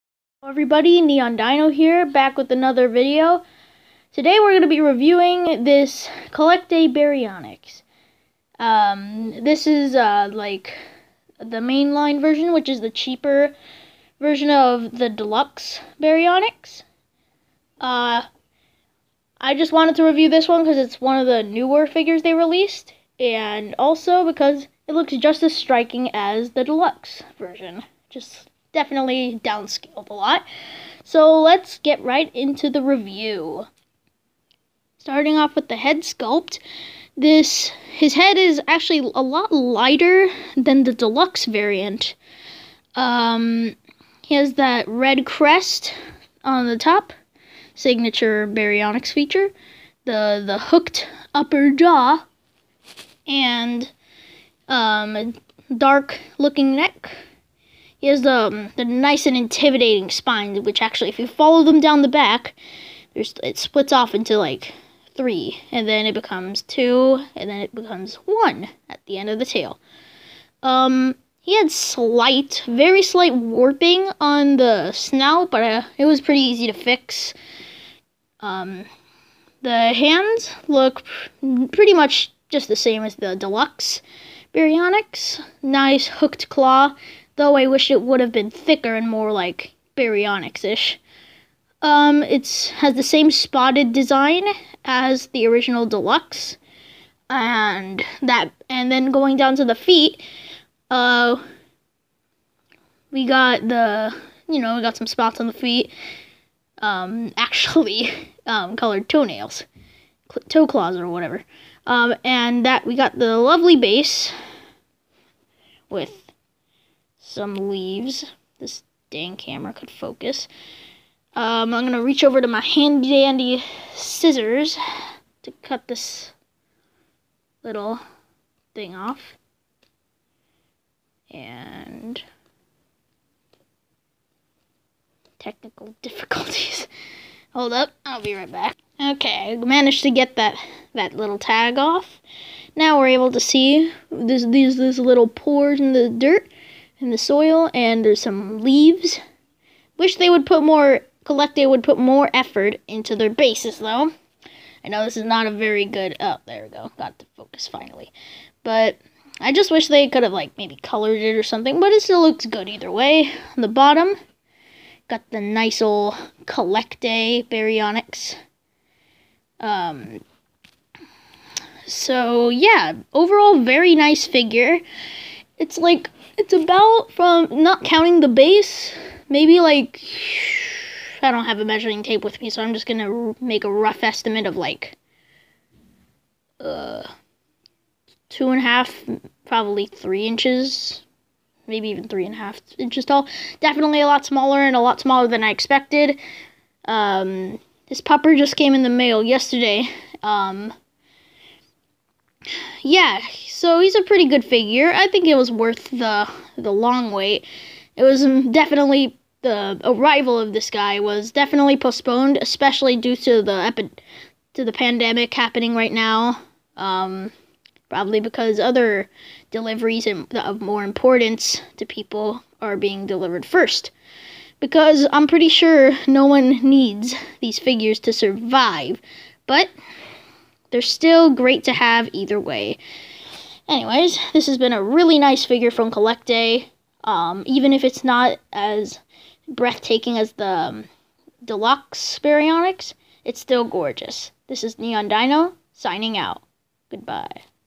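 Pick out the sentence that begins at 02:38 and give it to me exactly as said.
But I just wish they could have like maybe colored it or something, but it still looks good either way.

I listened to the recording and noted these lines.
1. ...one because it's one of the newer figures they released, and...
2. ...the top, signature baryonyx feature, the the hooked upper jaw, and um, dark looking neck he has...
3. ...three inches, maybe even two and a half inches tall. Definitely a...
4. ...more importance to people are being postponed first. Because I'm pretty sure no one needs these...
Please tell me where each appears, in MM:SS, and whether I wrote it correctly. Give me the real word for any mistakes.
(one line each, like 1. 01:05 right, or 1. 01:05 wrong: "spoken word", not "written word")
1. 00:20 right
2. 00:46 right
3. 03:09 wrong: "three", not "two"
4. 03:40 wrong: "delivered", not "postponed".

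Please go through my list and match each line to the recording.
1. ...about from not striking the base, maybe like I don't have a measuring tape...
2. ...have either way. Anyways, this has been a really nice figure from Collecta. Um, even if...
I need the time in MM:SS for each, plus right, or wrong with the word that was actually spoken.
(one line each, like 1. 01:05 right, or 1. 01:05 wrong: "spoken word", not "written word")
1. 02:56 wrong: "counting", not "striking"
2. 03:51 right.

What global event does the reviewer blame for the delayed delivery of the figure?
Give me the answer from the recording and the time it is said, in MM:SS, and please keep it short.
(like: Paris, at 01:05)
the pandemic, at 03:34.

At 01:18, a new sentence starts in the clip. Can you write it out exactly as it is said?
Um, the hands look pr pretty much just the same as the deluxe Baryonyx.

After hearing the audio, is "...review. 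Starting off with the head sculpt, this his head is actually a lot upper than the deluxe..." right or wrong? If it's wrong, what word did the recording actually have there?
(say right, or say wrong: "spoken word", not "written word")
wrong: "lighter", not "upper".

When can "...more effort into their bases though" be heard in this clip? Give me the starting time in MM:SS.
02:31.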